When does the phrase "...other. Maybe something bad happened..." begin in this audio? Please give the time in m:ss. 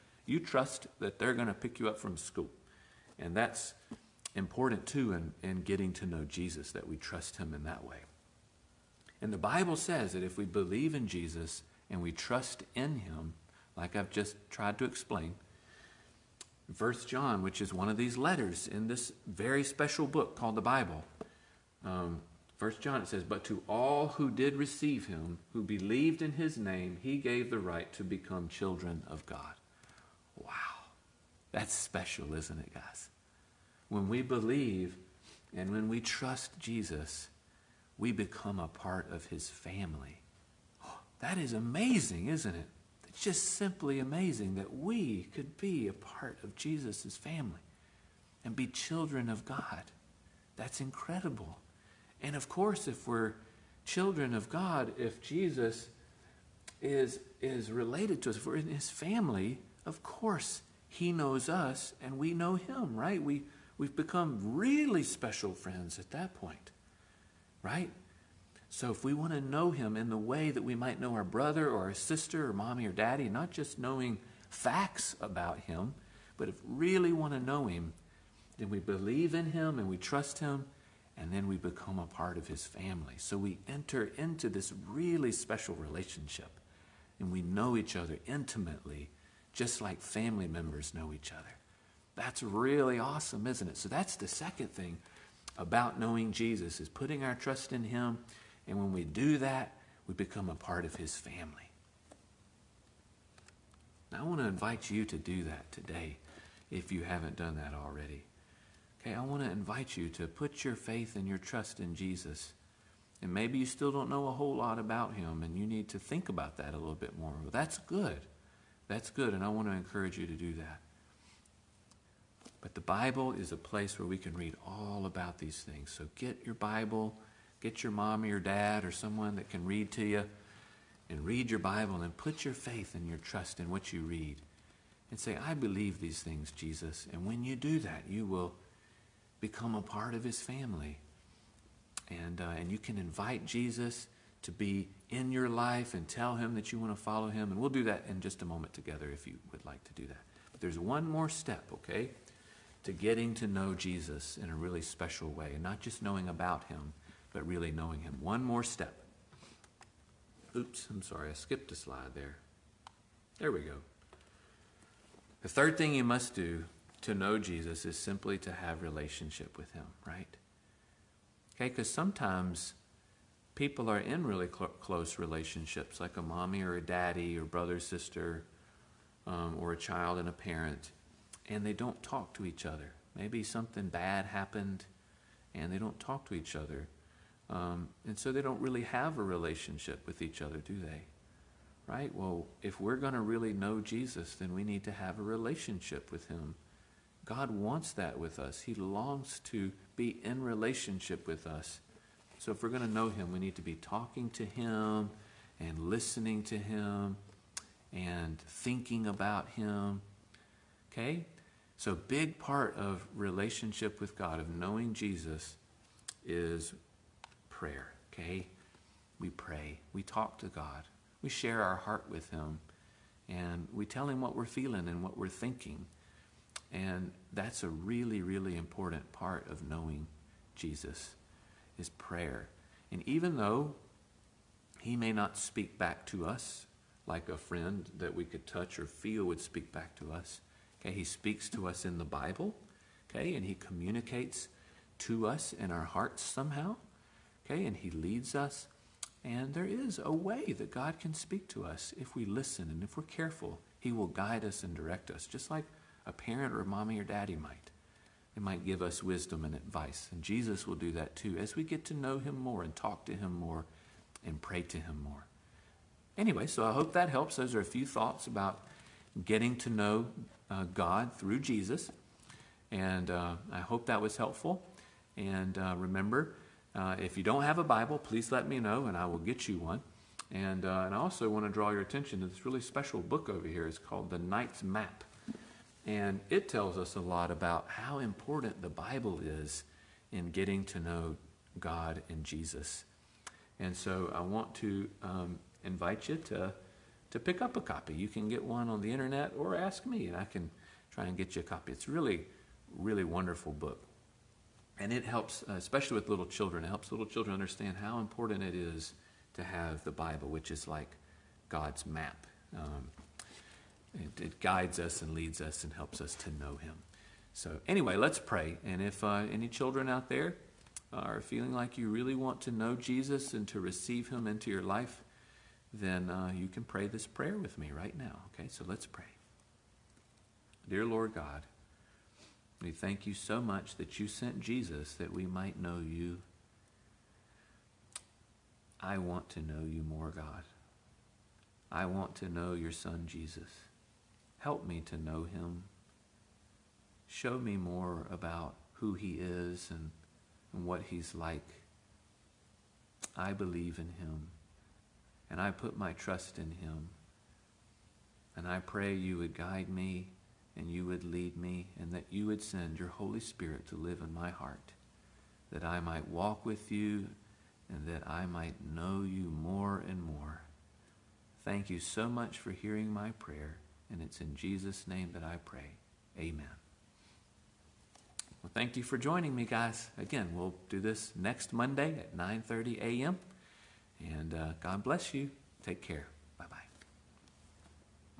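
3:02.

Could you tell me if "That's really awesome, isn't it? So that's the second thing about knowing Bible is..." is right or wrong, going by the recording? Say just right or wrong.
wrong.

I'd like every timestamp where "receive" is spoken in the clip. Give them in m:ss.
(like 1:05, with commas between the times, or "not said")
0:24, 5:23.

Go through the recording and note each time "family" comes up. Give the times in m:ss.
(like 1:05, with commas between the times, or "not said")
0:39, 0:47, 0:58, 1:22, 1:30, 1:41, 2:20.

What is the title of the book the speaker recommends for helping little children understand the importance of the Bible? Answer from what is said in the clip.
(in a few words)
The Knight's Map.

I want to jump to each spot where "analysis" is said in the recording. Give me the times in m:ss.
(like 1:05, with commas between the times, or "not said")
not said.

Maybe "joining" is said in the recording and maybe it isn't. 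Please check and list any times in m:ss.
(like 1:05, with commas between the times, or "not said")
6:18.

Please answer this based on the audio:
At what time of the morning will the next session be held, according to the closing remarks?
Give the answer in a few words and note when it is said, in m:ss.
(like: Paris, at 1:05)
9:30 a.m., at 6:22.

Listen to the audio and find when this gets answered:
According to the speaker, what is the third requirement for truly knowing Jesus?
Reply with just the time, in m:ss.
2:48.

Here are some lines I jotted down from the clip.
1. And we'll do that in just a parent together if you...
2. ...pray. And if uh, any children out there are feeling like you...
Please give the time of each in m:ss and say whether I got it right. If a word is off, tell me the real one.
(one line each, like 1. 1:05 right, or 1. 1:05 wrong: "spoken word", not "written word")
1. 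2:27 wrong: "moment", not "parent"
2. 5:18 right.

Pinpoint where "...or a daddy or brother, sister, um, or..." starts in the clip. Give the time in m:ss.
2:56.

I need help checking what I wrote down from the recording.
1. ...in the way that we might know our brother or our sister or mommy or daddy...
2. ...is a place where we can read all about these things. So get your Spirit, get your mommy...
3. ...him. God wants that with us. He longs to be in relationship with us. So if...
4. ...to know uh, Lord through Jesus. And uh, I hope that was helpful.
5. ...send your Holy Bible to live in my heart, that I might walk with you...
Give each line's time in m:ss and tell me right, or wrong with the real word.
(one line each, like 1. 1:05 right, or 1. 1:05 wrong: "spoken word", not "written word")
1. 1:09 right
2. 2:03 wrong: "Bible", not "Spirit"
3. 3:16 right
4. 4:29 wrong: "God", not "Lord"
5. 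6:02 wrong: "Spirit", not "Bible".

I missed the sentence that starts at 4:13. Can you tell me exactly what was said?
He will guide us and direct us, just like a parent or a mommy or daddy might.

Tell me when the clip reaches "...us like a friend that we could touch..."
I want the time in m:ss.
3:56.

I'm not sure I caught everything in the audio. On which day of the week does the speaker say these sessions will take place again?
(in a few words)
Monday.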